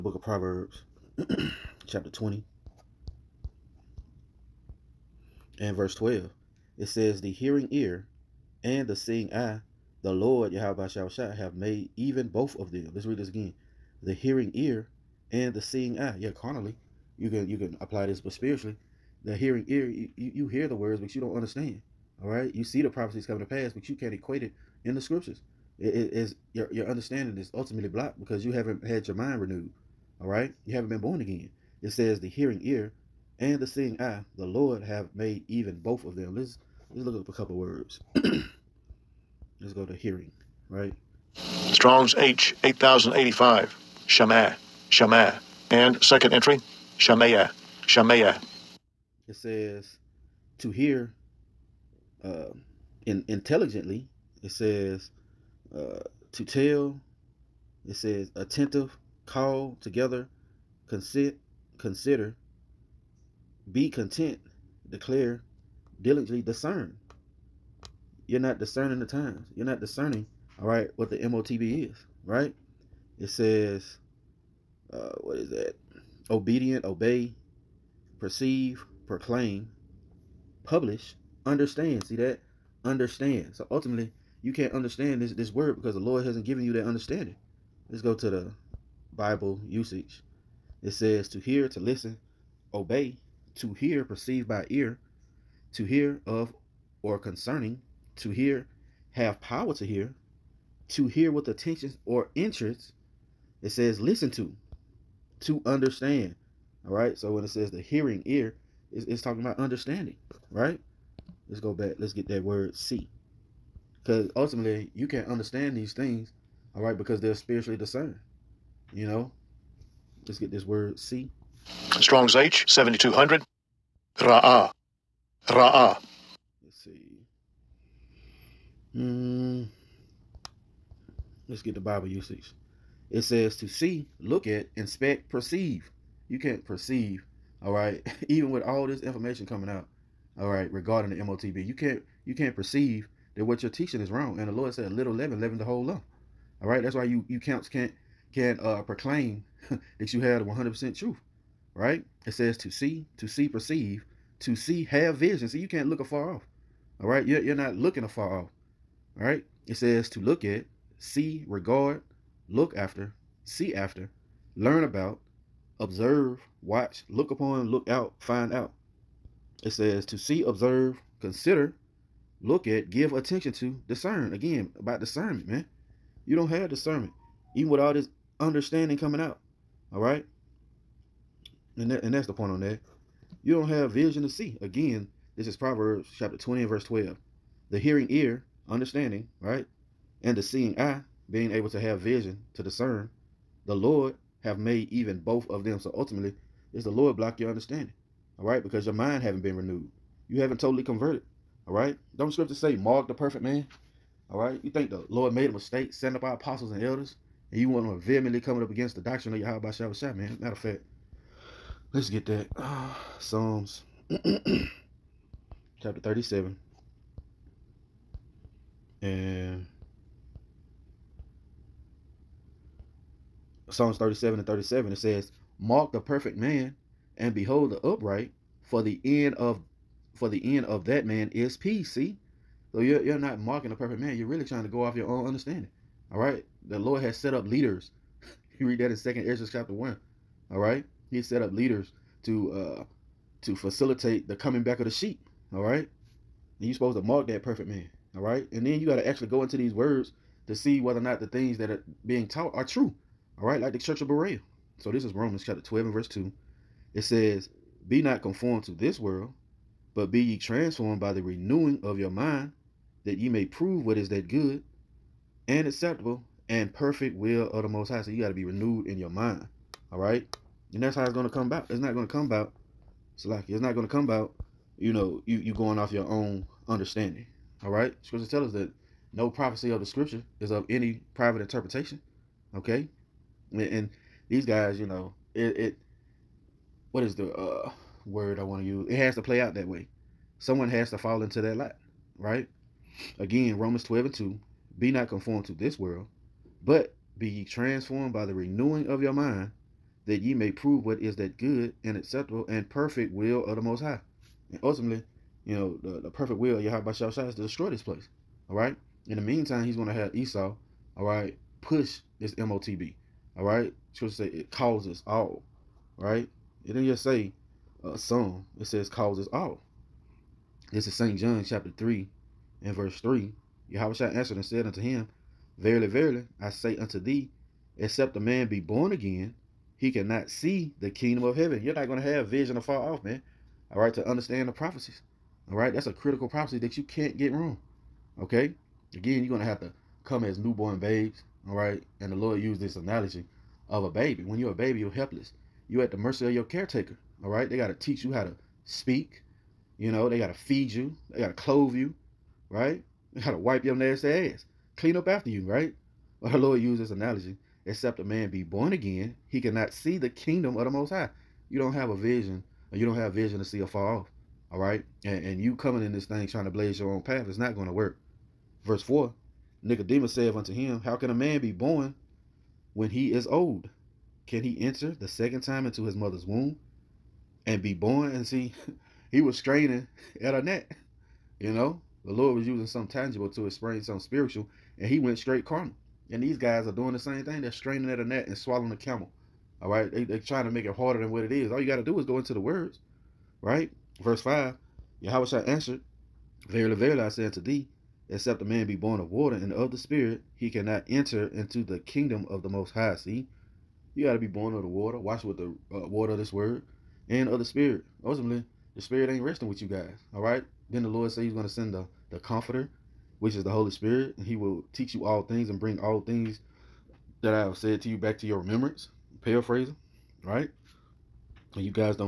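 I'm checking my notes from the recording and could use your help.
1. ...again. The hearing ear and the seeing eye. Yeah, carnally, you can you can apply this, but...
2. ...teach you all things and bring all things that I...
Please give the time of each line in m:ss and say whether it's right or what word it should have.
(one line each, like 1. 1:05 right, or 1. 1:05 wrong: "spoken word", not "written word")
1. 0:13 right
2. 6:54 right.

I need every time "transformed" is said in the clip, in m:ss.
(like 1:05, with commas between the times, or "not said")
4:20, 4:57.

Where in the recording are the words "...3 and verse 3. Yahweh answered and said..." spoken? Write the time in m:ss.
5:21.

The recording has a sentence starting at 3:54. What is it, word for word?
You're really trying to go off your own understanding.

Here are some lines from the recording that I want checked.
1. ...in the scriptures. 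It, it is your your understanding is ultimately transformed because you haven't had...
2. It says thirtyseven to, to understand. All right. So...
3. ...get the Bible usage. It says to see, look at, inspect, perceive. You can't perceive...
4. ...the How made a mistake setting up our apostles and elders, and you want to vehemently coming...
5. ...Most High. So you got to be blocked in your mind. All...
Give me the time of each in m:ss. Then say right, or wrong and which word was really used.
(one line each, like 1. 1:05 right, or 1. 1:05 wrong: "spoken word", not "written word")
1. 0:24 wrong: "blocked", not "transformed"
2. 1:43 wrong: "listen", not "thirtyseven"
3. 2:11 right
4. 3:24 wrong: "Lord", not "How"
5. 4:27 wrong: "renewed", not "blocked".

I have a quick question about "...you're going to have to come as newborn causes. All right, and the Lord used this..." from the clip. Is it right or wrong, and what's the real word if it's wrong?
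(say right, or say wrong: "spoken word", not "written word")
wrong: "babes", not "causes".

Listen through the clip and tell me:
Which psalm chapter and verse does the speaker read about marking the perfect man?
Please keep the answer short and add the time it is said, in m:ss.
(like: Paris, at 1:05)
Psalms 37:37, at 3:43.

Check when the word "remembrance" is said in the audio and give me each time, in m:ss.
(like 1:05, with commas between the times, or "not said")
6:58.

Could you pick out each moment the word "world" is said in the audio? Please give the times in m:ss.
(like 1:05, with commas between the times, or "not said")
4:18, 4:55.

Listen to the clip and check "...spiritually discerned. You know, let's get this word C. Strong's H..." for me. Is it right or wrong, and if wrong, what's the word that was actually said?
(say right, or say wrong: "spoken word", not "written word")
right.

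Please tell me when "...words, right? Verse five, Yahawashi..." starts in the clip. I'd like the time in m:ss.
6:32.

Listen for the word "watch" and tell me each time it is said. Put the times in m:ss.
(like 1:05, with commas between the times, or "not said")
2:46, 6:44.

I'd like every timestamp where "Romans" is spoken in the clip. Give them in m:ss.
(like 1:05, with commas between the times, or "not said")
4:15, 4:53.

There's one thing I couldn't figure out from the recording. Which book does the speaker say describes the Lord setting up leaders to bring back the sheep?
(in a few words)
Second Esdras.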